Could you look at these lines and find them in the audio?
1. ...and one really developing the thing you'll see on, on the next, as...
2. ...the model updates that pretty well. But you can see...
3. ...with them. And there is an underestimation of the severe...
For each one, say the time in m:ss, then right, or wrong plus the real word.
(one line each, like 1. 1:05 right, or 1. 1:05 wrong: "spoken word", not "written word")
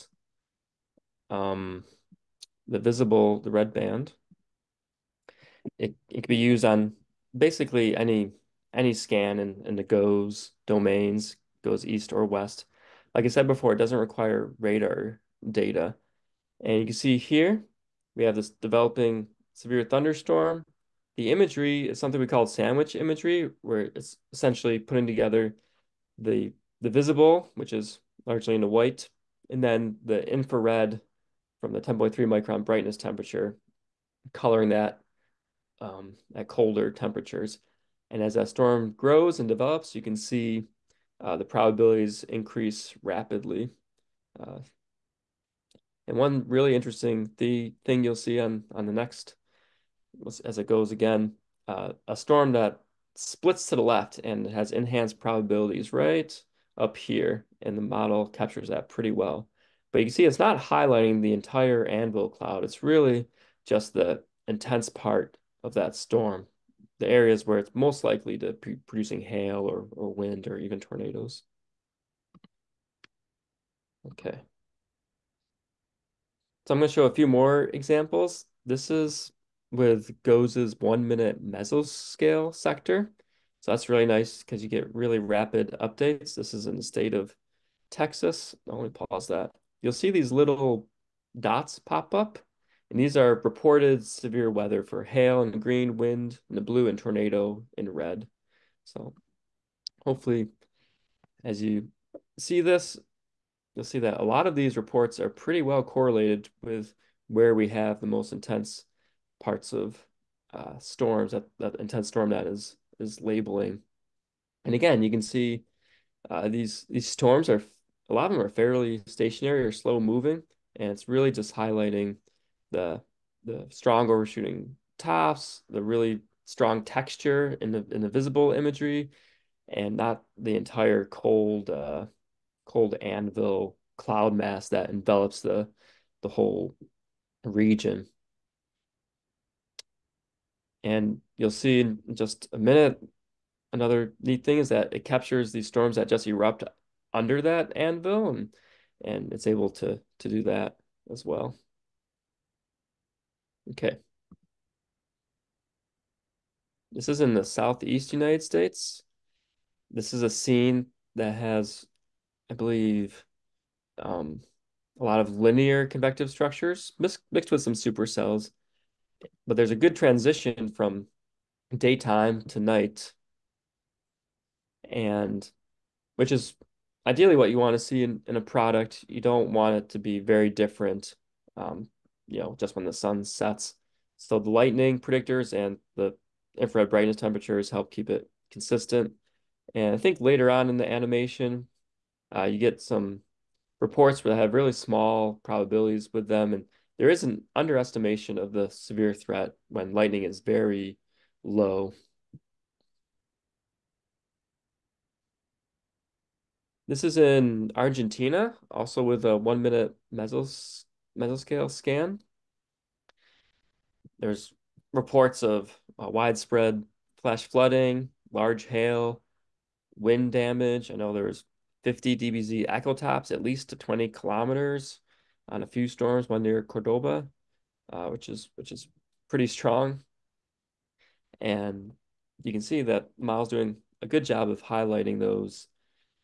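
1. 0:46 wrong: "interesting", not "developing"
2. 0:57 wrong: "captures", not "updates"
3. 3:16 right.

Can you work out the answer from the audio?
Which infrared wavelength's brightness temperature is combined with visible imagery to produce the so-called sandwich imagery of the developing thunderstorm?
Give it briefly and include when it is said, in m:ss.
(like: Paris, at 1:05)
10.3 micron, at 0:31.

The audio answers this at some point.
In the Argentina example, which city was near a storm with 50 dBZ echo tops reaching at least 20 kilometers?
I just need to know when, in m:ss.
3:46.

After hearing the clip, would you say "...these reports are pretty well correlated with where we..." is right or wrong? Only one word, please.
right.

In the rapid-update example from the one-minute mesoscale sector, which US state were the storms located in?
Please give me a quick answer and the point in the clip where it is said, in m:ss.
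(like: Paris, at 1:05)
Texas, at 1:27.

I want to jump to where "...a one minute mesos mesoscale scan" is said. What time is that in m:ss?
3:29.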